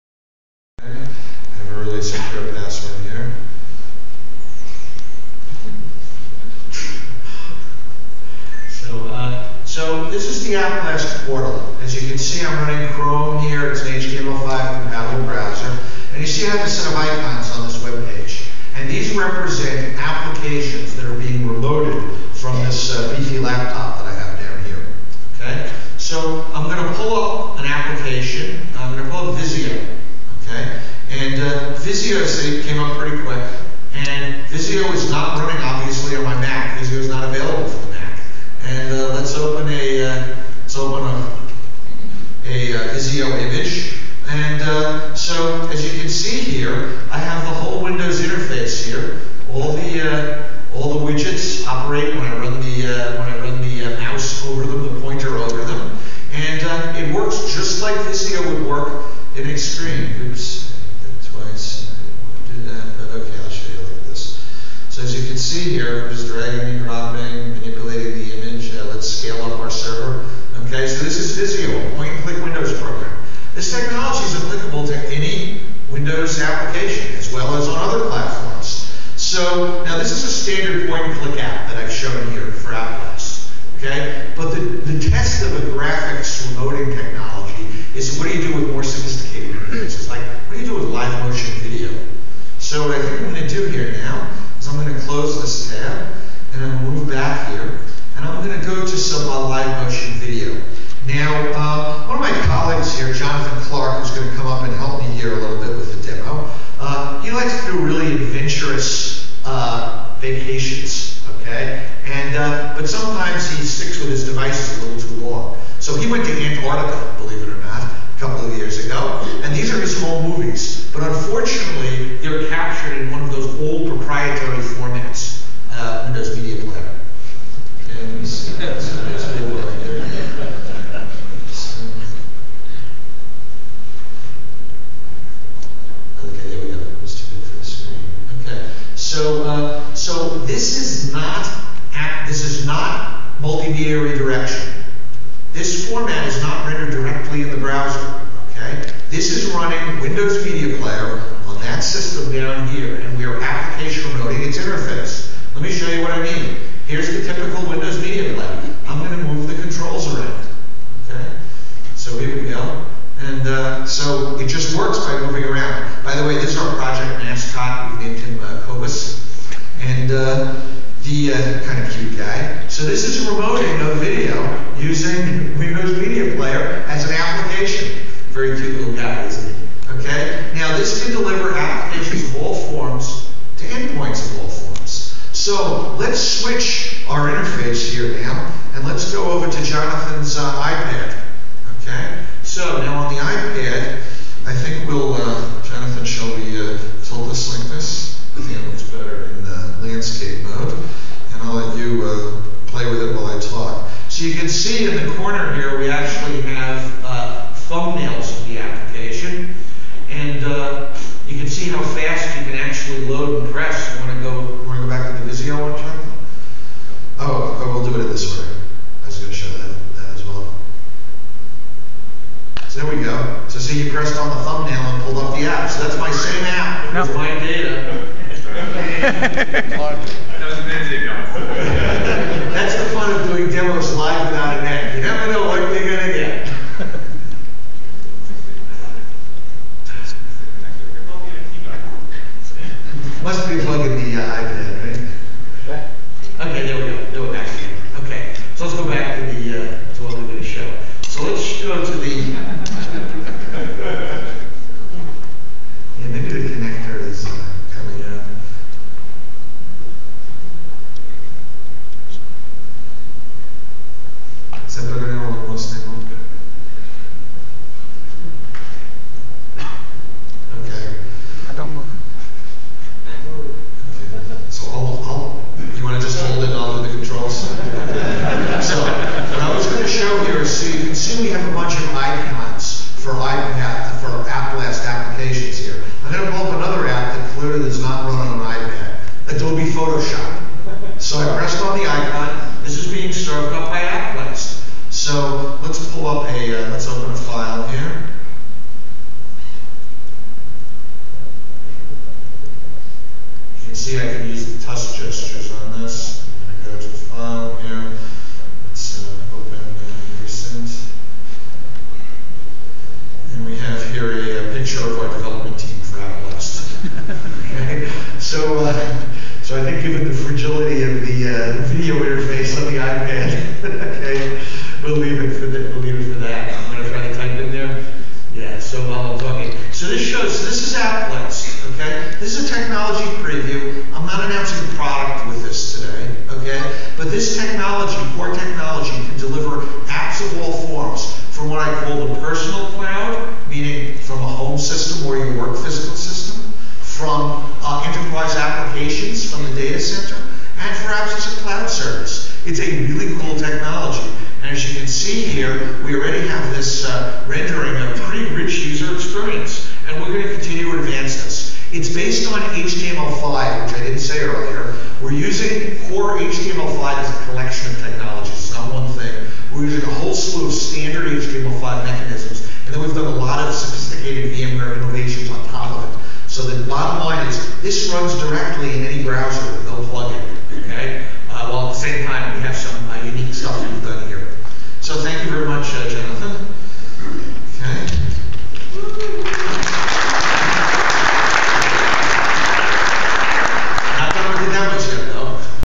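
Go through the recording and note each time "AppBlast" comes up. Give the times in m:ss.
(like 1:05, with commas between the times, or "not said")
0:10, 1:22, 4:53, 5:30.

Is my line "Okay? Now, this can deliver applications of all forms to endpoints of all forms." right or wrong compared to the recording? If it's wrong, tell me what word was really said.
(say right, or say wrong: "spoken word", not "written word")
right.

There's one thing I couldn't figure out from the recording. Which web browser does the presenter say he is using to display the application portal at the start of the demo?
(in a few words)
Chrome.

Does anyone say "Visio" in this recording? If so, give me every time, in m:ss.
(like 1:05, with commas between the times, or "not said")
0:42, 0:58, 1:11, 3:35.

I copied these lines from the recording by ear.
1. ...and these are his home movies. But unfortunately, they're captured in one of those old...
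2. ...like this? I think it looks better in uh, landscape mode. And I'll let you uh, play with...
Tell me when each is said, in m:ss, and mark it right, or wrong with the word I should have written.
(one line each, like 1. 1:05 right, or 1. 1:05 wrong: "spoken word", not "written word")
1. 1:59 right
2. 3:17 right.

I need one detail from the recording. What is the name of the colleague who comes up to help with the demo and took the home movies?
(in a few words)
Jonathan Clark.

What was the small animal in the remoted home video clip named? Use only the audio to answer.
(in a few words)
Cobus.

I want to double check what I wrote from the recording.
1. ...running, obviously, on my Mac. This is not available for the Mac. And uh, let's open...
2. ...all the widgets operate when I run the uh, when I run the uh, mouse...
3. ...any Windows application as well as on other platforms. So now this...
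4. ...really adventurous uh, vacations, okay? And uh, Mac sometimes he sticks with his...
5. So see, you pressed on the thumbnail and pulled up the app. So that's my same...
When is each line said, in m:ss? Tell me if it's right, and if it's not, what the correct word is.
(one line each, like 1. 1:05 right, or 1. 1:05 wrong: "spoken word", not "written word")
1. 0:35 right
2. 0:50 right
3. 1:15 right
4. 1:47 wrong: "But", not "Mac"
5. 3:43 right.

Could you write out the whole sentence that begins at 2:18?
Okay, so uh, so this is not this is not multimedia redirection.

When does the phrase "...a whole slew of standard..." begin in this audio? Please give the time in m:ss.
6:09.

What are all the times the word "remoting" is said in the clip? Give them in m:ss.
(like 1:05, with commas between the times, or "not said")
1:26, 2:34, 2:53.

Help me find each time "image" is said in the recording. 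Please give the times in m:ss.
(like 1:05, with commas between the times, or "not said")
0:43, 1:08.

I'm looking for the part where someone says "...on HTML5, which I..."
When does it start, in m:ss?
6:02.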